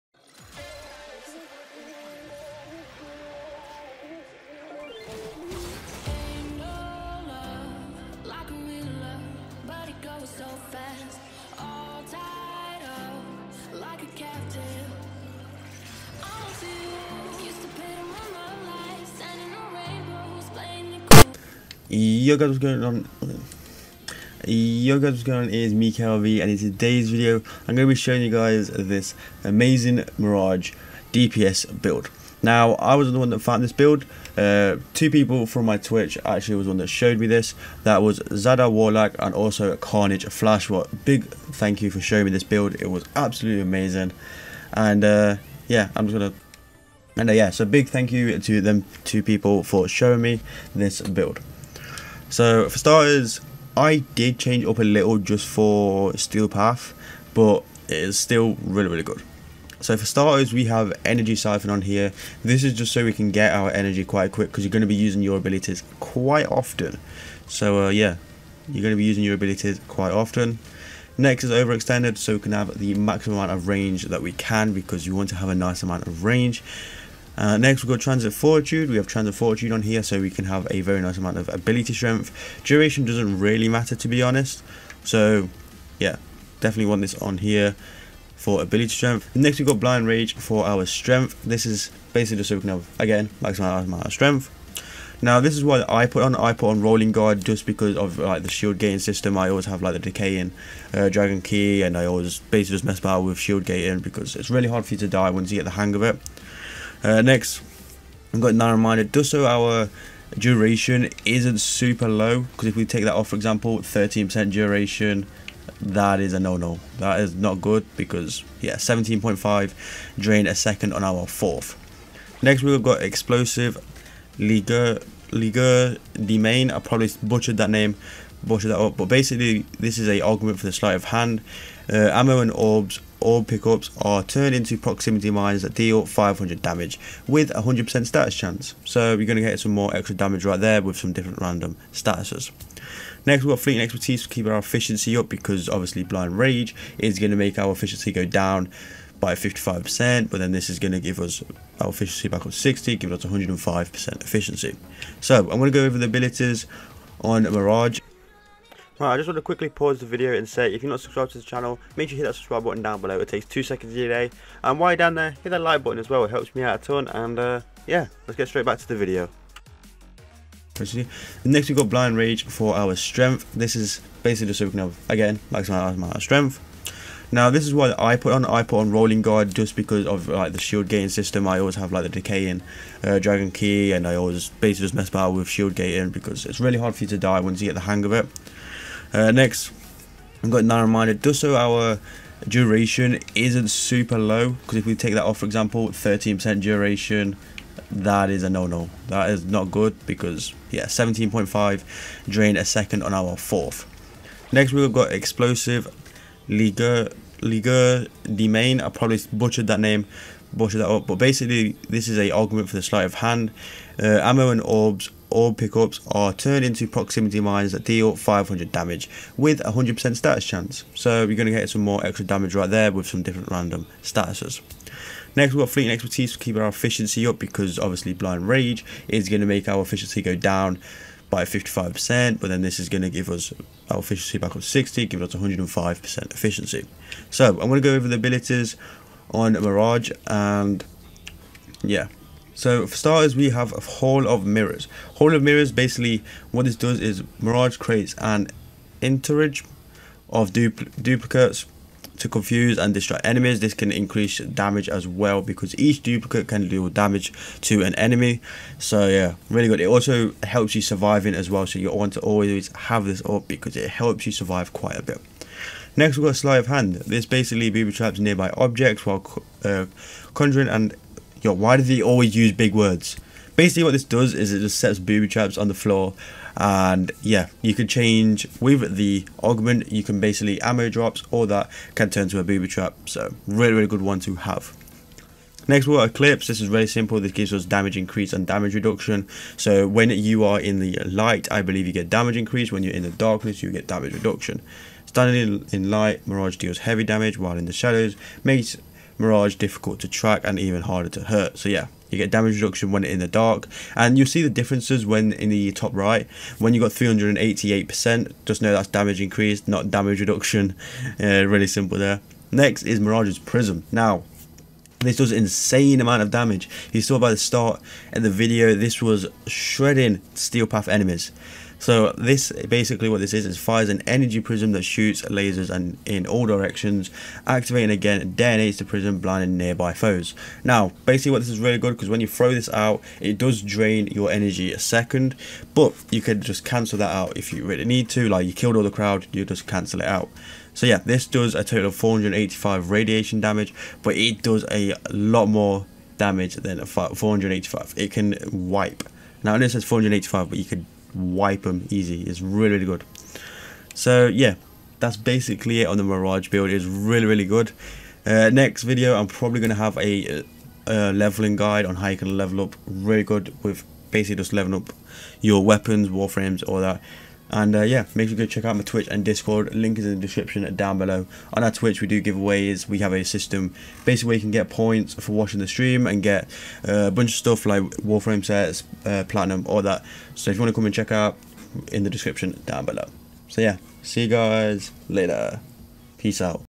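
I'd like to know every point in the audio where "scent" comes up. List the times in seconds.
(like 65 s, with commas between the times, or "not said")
not said.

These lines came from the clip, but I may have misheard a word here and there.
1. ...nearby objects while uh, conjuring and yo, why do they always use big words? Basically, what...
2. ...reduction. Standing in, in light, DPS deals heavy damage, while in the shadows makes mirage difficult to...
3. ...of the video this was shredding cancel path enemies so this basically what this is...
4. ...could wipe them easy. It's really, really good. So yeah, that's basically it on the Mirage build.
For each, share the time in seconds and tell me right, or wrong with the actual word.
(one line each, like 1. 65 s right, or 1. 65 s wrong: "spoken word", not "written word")
1. 268 s right
2. 294 s wrong: "Mirage", not "DPS"
3. 318 s wrong: "steel", not "cancel"
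4. 350 s right.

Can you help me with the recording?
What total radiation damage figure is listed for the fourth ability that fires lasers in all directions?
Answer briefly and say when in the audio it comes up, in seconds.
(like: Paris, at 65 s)
485, at 341 s.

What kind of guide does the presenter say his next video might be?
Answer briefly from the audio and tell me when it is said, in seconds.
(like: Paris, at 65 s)
leveling guide, at 361 s.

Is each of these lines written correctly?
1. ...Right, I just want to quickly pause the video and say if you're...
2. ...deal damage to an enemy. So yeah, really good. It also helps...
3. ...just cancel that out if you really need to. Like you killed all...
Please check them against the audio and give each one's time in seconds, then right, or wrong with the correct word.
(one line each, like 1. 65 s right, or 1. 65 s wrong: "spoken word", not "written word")
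1. 159 s right
2. 256 s right
3. 336 s right.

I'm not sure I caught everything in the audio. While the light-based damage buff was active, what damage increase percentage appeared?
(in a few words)
388%.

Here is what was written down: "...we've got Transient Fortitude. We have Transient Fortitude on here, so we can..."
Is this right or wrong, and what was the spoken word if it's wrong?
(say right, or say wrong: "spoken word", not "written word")
right.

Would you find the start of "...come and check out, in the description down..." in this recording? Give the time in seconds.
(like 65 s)
380 s.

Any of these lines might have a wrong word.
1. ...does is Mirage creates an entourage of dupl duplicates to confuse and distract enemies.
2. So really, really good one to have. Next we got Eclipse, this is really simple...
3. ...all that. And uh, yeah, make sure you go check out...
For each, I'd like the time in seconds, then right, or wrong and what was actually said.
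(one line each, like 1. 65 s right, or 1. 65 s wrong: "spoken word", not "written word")
1. 246 s right
2. 283 s right
3. 366 s right.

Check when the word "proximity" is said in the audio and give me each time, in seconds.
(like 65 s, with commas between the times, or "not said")
134 s, 216 s.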